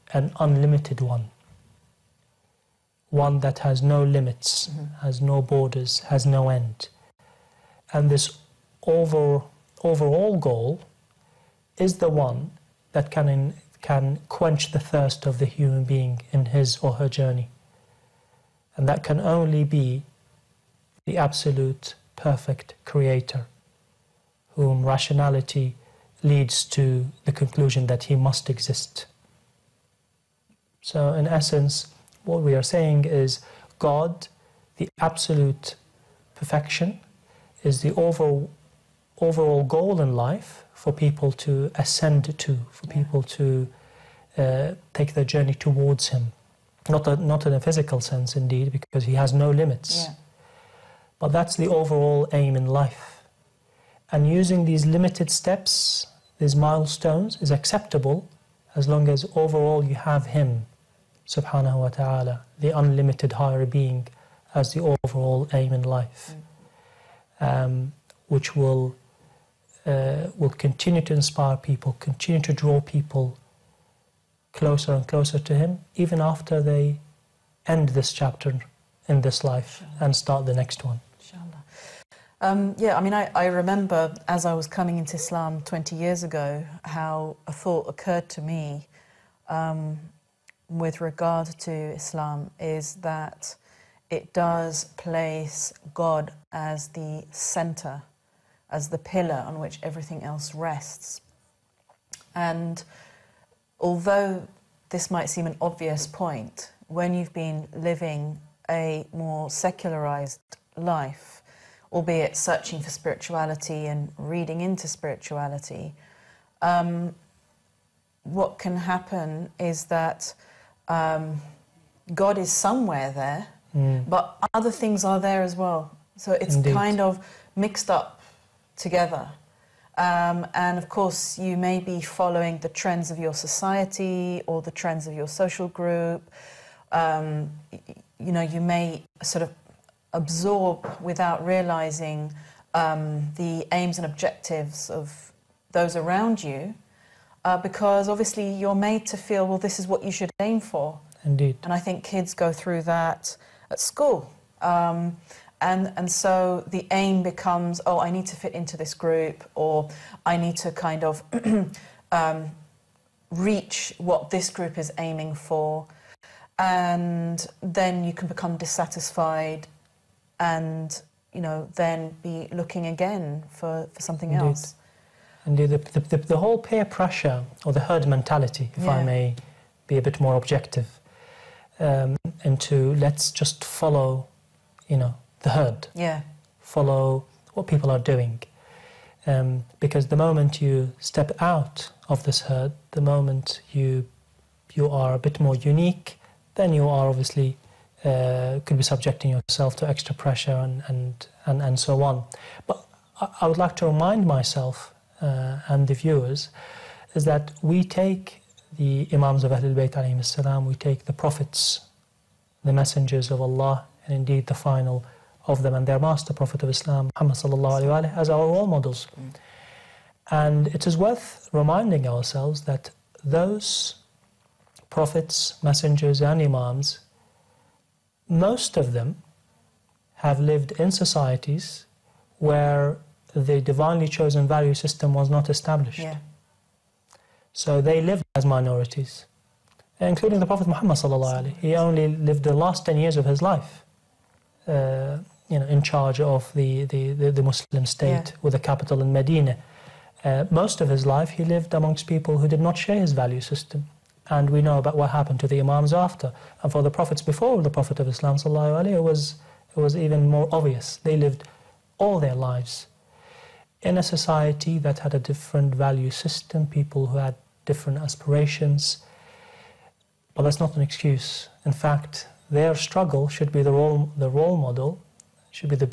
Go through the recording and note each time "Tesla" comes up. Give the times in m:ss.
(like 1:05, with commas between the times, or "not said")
not said.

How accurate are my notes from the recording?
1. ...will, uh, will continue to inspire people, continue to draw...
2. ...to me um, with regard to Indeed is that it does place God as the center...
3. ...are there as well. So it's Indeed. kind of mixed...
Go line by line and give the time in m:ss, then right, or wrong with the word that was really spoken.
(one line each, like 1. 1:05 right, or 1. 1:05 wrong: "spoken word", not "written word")
1. 1:08 right
2. 1:28 wrong: "Islam", not "Indeed"
3. 2:05 right.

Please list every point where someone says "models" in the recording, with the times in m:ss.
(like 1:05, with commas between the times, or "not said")
3:38, 4:34.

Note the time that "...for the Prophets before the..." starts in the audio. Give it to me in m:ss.
4:16.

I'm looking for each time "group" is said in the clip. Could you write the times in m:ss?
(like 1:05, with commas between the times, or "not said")
2:15, 2:38, 2:44.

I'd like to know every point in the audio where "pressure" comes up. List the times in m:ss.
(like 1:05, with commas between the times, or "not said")
2:56, 3:20.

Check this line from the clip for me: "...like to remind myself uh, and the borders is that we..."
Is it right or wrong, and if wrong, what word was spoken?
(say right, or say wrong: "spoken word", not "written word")
wrong: "viewers", not "borders".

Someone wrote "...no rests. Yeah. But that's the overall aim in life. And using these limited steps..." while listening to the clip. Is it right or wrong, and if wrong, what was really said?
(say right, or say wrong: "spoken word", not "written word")
wrong: "limits", not "rests".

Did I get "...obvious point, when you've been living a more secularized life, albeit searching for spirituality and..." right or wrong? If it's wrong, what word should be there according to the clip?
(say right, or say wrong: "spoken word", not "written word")
right.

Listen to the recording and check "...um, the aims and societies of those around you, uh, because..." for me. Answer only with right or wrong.
wrong.